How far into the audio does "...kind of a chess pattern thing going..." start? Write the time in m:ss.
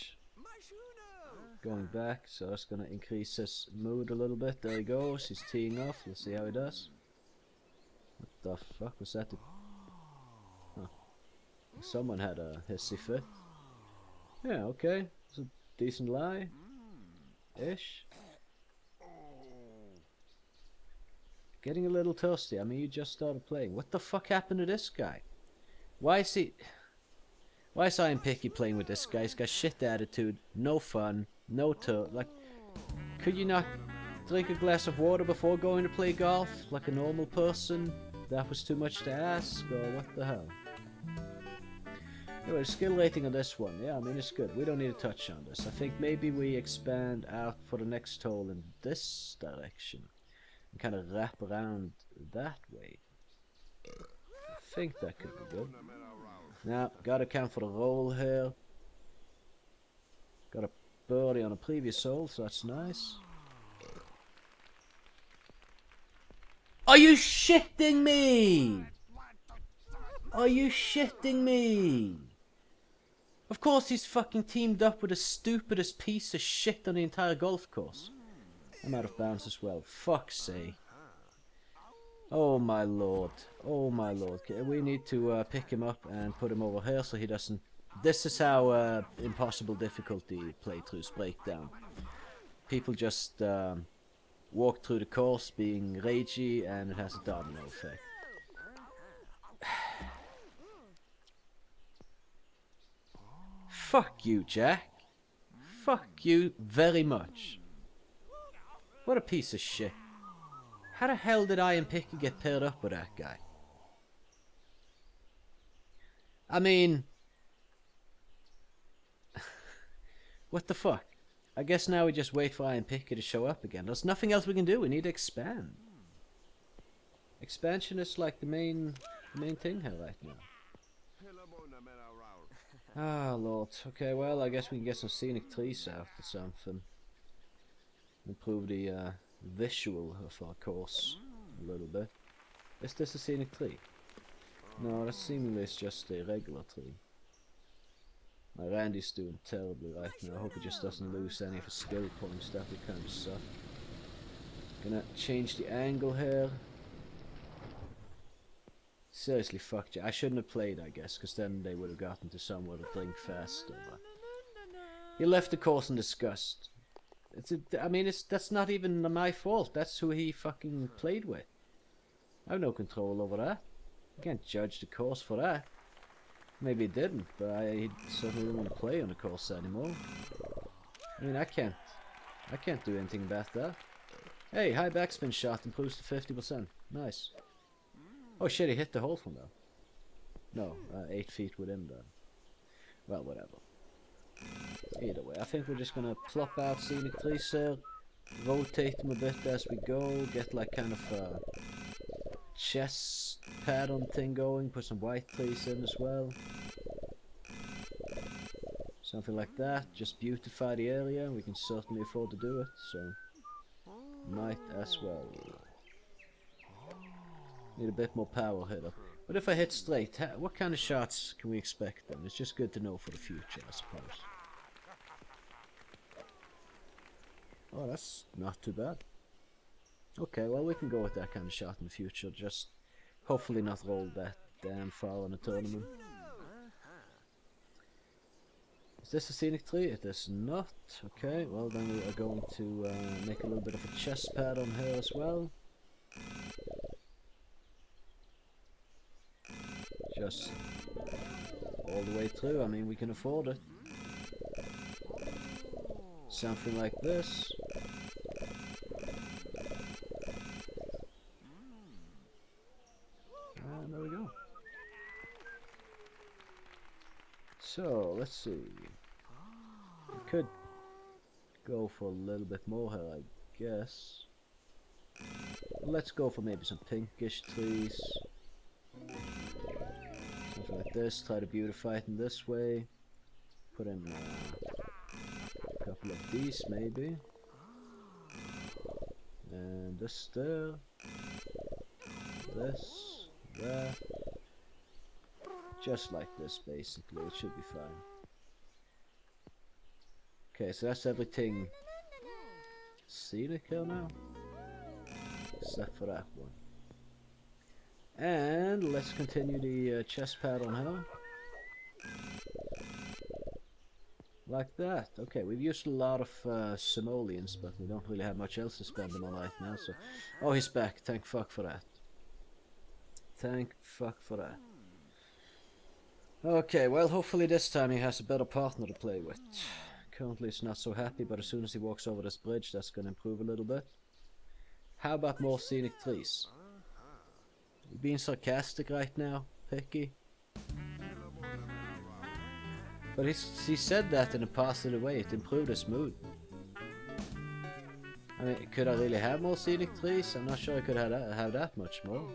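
3:20.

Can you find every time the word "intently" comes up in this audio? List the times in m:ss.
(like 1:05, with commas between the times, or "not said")
not said.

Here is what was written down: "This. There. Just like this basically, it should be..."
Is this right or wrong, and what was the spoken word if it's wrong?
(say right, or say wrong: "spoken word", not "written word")
right.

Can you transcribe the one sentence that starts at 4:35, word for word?
Let's go for maybe some pinkish trees.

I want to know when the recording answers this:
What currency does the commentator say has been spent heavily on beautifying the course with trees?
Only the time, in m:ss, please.
5:16.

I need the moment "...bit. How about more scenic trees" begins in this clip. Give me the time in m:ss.
5:33.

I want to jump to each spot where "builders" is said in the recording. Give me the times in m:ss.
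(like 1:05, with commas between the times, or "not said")
not said.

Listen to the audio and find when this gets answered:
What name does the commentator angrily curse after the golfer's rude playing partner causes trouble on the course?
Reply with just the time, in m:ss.
1:44.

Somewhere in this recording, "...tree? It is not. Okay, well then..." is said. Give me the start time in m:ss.
3:59.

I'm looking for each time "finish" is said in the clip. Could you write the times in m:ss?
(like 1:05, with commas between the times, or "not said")
not said.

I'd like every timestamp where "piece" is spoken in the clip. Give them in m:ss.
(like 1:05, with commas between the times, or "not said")
1:15, 1:49.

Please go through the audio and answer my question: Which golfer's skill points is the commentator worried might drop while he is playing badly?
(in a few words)
Randy.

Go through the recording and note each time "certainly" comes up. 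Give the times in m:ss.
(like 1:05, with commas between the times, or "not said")
2:58, 3:31.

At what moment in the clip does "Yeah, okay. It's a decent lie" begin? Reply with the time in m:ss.
0:14.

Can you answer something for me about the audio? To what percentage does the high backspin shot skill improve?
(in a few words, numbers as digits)
50%.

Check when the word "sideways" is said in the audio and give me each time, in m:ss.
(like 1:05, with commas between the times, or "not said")
not said.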